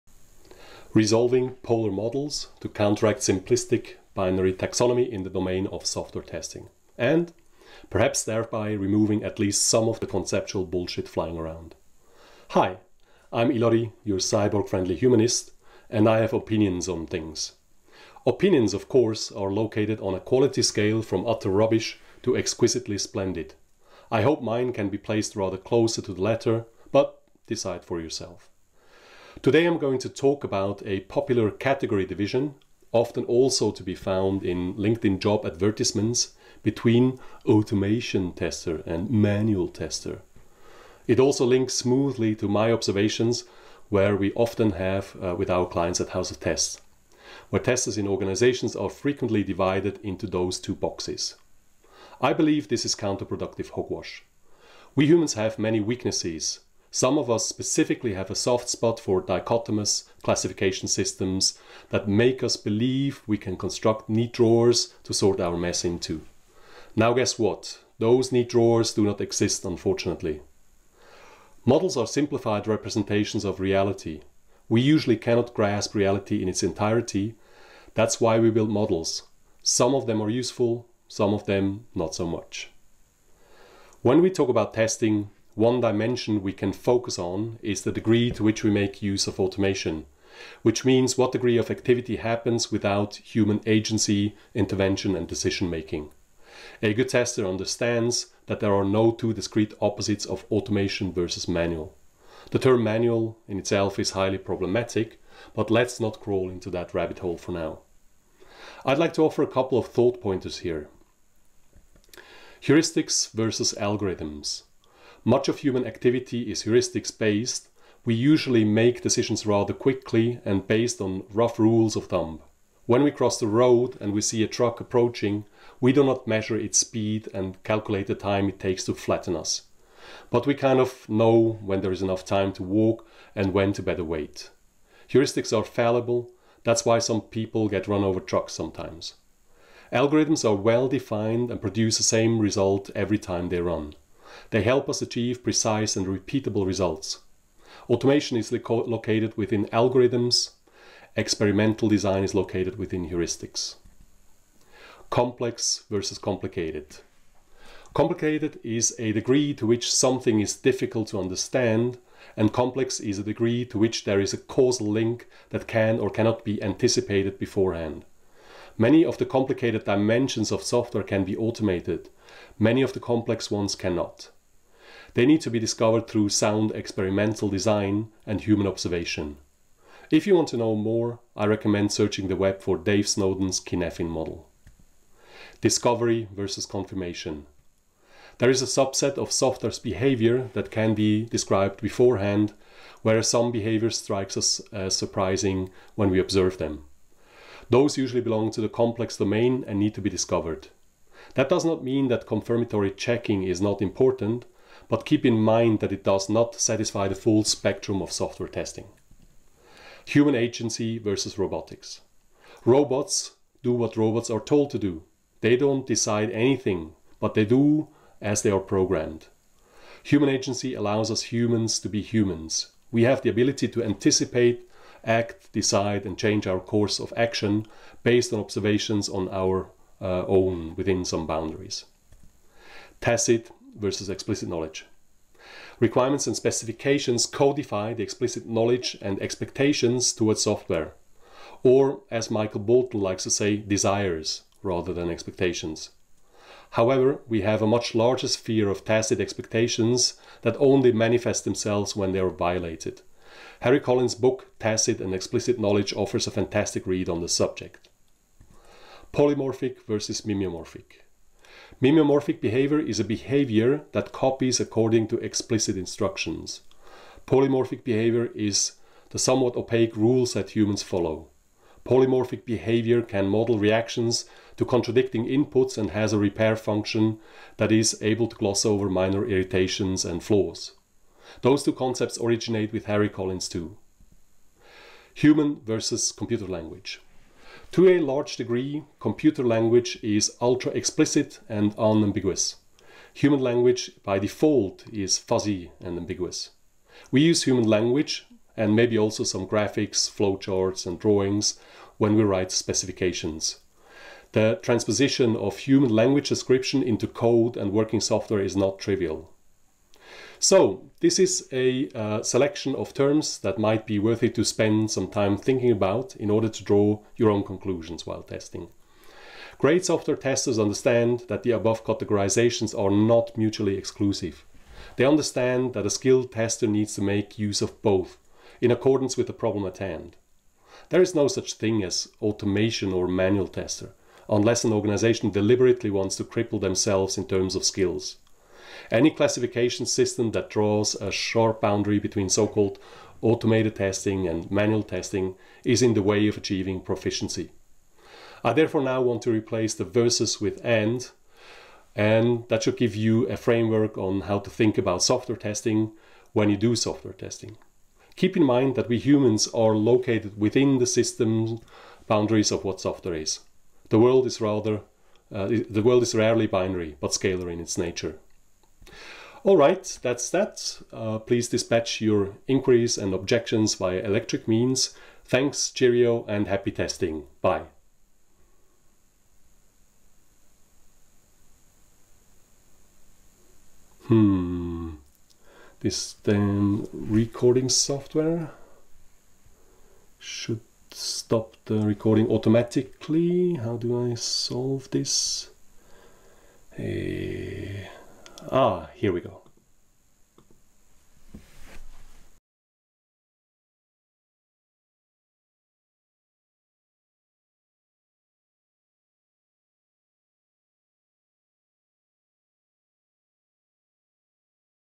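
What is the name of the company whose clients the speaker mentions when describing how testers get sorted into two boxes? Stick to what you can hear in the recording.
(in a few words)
House of Tests.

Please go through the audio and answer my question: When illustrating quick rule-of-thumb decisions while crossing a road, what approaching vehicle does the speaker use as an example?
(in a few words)
Truck.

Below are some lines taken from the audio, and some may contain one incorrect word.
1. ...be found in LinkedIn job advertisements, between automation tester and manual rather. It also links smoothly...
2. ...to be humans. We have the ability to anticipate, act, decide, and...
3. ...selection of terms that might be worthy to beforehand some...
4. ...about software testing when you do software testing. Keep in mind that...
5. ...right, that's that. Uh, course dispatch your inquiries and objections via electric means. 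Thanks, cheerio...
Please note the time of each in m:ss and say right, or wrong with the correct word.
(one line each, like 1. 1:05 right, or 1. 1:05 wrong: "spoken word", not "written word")
1. 0:33 wrong: "tester", not "rather"
2. 3:41 right
3. 5:12 wrong: "spend", not "beforehand"
4. 5:54 right
5. 6:09 wrong: "please", not "course".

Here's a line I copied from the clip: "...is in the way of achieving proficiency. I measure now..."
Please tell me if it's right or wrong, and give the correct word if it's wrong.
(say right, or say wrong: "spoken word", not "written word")
wrong: "therefore", not "measure".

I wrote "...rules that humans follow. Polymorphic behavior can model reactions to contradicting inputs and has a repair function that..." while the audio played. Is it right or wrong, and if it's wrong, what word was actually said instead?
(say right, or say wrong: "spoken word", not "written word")
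right.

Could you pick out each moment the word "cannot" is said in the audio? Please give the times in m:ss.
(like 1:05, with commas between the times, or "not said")
1:15, 2:46, 2:53.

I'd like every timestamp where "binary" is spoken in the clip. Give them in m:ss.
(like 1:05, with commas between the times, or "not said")
0:04, 6:06.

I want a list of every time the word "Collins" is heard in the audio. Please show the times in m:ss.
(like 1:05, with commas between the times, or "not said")
4:13, 4:43.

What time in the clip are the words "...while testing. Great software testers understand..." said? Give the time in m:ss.
5:18.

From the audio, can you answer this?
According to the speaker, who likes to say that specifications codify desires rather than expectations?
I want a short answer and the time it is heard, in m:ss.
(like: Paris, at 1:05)
Michael Bolton, at 4:02.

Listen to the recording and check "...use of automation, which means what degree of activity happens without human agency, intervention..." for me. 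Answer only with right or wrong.
right.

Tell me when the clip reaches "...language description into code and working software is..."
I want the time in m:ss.
5:05.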